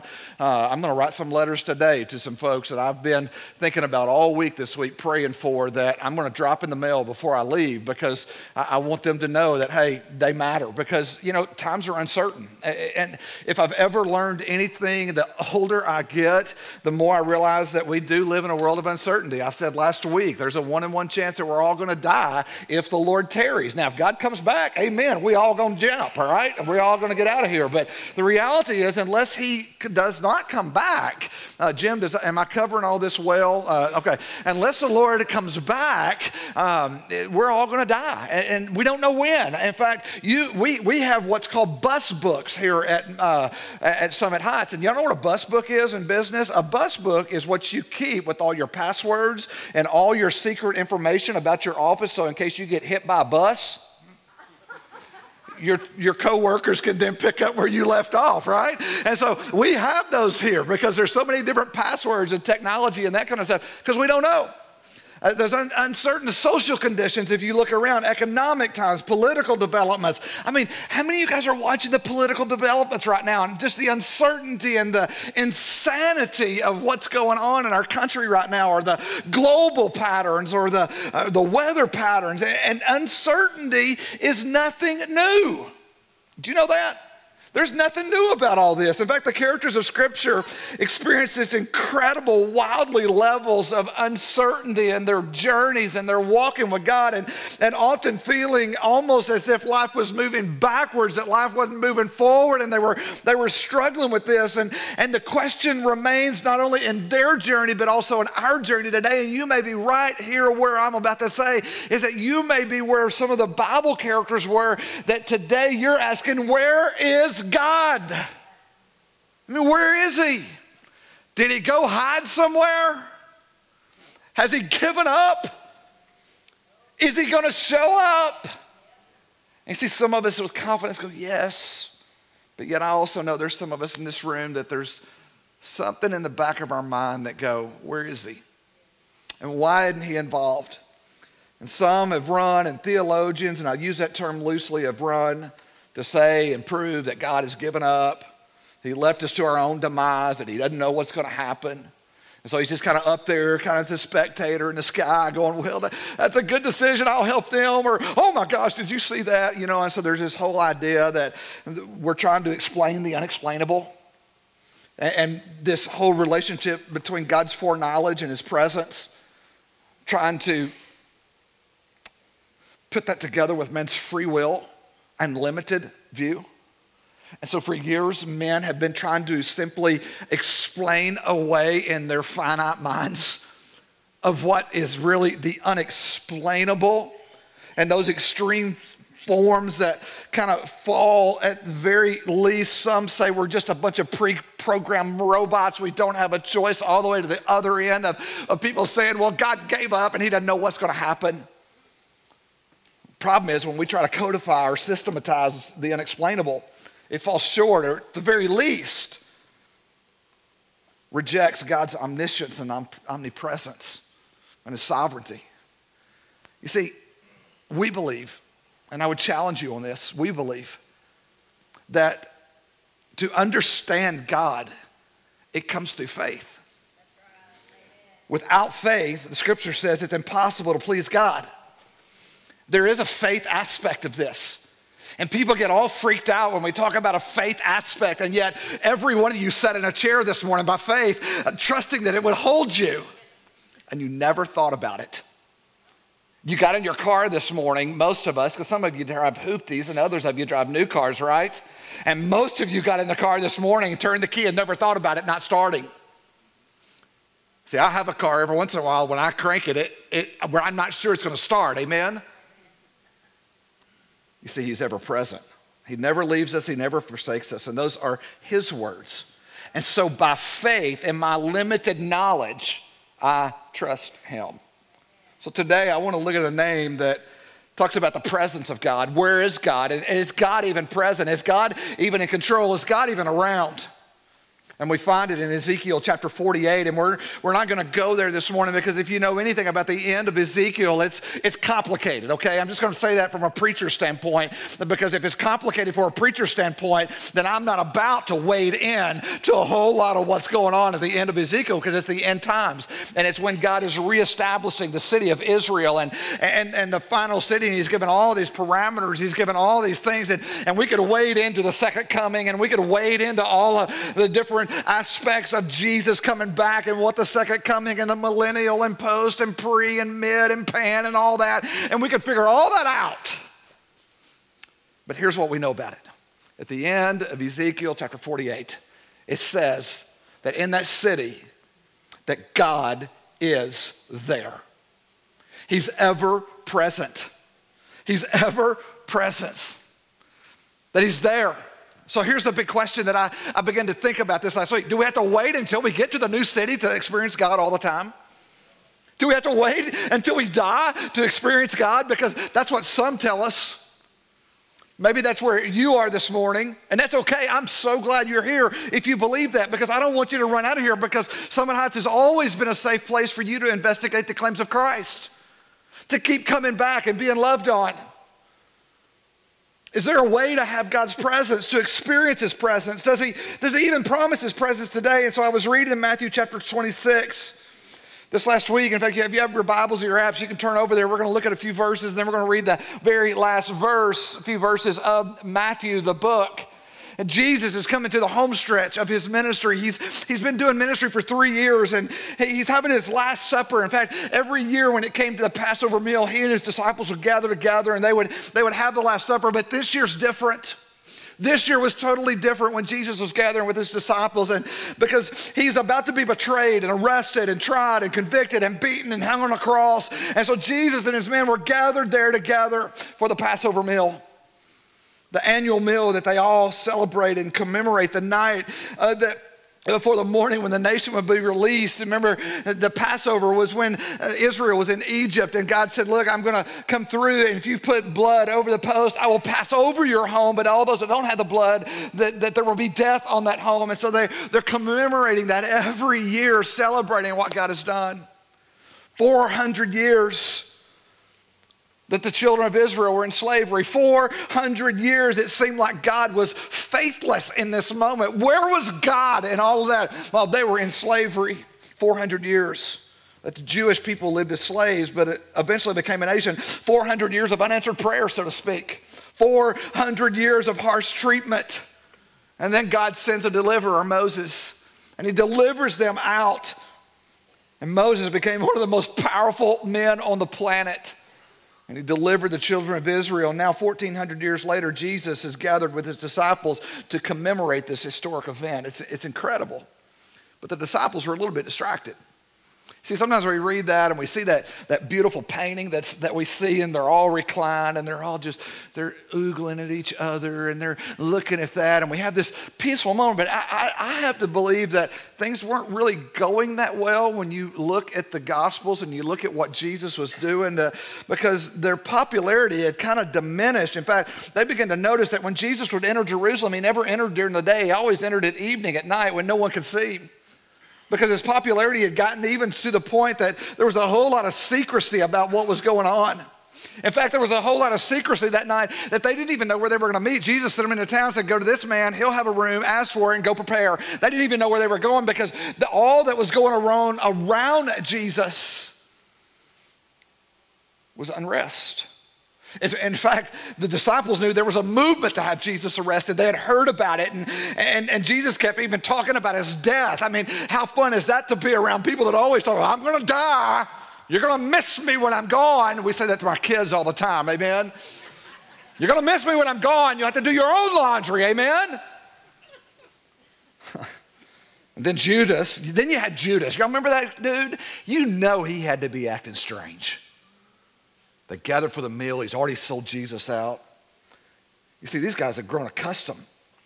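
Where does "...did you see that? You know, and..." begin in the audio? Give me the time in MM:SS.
02:38.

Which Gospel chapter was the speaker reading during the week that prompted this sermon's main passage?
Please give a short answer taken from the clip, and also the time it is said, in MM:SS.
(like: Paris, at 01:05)
Matthew 26, at 06:15.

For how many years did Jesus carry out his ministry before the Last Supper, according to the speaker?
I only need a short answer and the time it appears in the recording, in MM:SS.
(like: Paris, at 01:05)
3, at 06:31.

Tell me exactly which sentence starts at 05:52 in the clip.
Because that's what some tell us.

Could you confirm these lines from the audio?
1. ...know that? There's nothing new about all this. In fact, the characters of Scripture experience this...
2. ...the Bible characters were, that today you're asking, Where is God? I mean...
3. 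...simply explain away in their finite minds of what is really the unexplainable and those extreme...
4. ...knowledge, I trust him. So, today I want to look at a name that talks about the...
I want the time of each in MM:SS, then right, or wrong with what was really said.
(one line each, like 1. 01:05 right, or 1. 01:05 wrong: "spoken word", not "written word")
1. 01:26 right
2. 01:53 right
3. 02:59 right
4. 04:31 right.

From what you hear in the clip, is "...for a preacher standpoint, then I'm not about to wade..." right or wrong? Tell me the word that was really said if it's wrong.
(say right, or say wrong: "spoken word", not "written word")
right.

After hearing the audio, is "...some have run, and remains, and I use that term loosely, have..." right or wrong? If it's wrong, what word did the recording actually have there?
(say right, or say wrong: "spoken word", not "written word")
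wrong: "theologians", not "remains".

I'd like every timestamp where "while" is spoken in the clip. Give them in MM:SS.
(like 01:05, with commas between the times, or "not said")
04:18, 07:30.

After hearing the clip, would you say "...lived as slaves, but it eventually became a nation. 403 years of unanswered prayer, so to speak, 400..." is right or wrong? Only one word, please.
wrong.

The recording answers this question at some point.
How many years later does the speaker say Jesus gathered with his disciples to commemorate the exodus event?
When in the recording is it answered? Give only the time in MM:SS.
07:53.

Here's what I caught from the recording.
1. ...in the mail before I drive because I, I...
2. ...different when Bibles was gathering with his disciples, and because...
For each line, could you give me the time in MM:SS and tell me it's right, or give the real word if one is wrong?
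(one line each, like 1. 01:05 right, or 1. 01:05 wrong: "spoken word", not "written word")
1. 00:06 wrong: "leave", not "drive"
2. 06:42 wrong: "Jesus", not "Bibles".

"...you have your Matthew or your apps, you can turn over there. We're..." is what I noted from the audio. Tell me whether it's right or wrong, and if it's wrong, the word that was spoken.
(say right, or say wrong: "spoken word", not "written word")
wrong: "Bibles", not "Matthew".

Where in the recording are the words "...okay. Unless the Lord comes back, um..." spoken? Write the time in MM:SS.
00:33.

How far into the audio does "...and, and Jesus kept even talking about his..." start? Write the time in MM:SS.
08:57.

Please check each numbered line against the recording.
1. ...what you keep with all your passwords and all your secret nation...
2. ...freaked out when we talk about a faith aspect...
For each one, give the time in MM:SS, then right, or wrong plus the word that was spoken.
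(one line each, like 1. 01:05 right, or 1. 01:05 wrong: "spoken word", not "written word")
1. 00:47 wrong: "information", not "nation"
2. 03:55 right.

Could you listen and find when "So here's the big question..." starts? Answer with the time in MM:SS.
05:42.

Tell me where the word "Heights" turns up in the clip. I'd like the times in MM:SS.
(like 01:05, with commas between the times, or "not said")
00:44, 06:01.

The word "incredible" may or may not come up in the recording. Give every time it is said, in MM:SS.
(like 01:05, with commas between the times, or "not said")
01:31, 07:59.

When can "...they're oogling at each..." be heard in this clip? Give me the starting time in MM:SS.
08:08.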